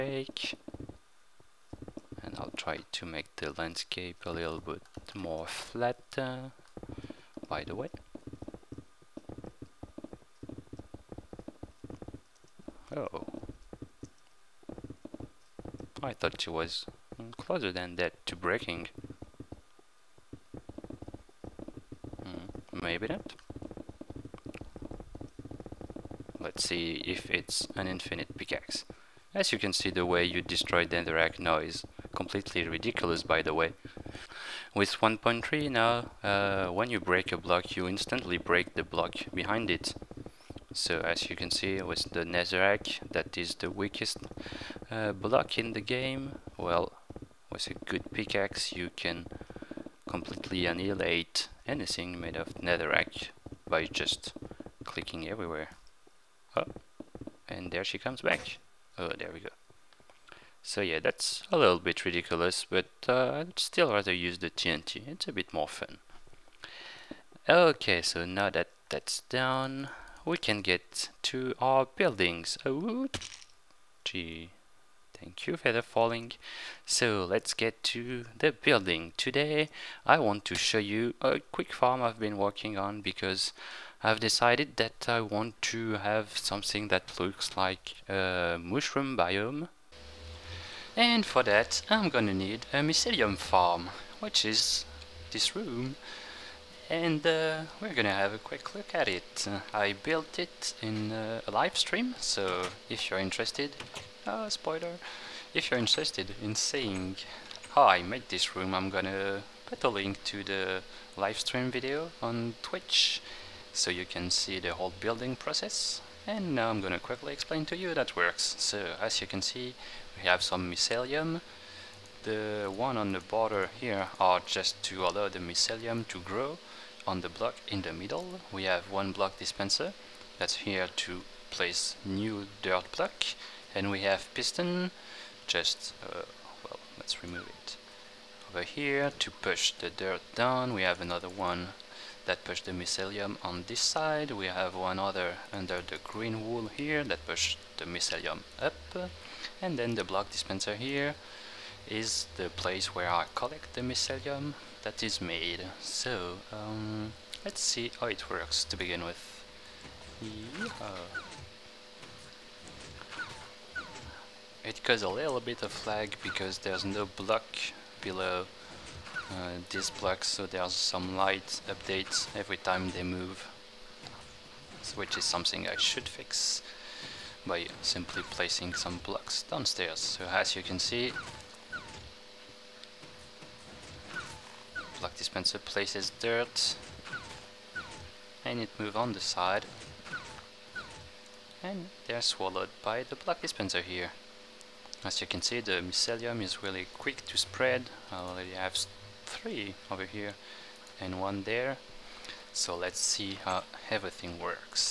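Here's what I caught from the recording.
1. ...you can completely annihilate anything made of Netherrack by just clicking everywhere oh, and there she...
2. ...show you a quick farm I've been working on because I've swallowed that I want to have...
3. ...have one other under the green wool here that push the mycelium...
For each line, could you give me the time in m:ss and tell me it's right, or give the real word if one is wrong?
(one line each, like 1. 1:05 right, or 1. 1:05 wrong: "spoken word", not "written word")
1. 0:48 right
2. 1:20 wrong: "decided", not "swallowed"
3. 2:24 right.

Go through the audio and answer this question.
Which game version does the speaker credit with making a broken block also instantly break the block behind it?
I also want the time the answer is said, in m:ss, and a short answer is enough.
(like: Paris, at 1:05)
1.3, at 0:34.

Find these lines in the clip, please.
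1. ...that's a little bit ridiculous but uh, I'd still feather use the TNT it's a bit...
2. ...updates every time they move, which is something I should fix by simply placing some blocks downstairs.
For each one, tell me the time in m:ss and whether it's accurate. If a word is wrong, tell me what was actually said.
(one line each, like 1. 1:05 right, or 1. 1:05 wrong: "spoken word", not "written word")
1. 1:00 wrong: "rather", not "feather"
2. 2:51 right.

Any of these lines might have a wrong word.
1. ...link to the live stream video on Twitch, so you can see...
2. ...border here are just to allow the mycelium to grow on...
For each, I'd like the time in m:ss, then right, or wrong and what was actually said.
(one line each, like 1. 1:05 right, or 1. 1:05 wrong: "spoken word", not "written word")
1. 1:49 right
2. 2:03 right.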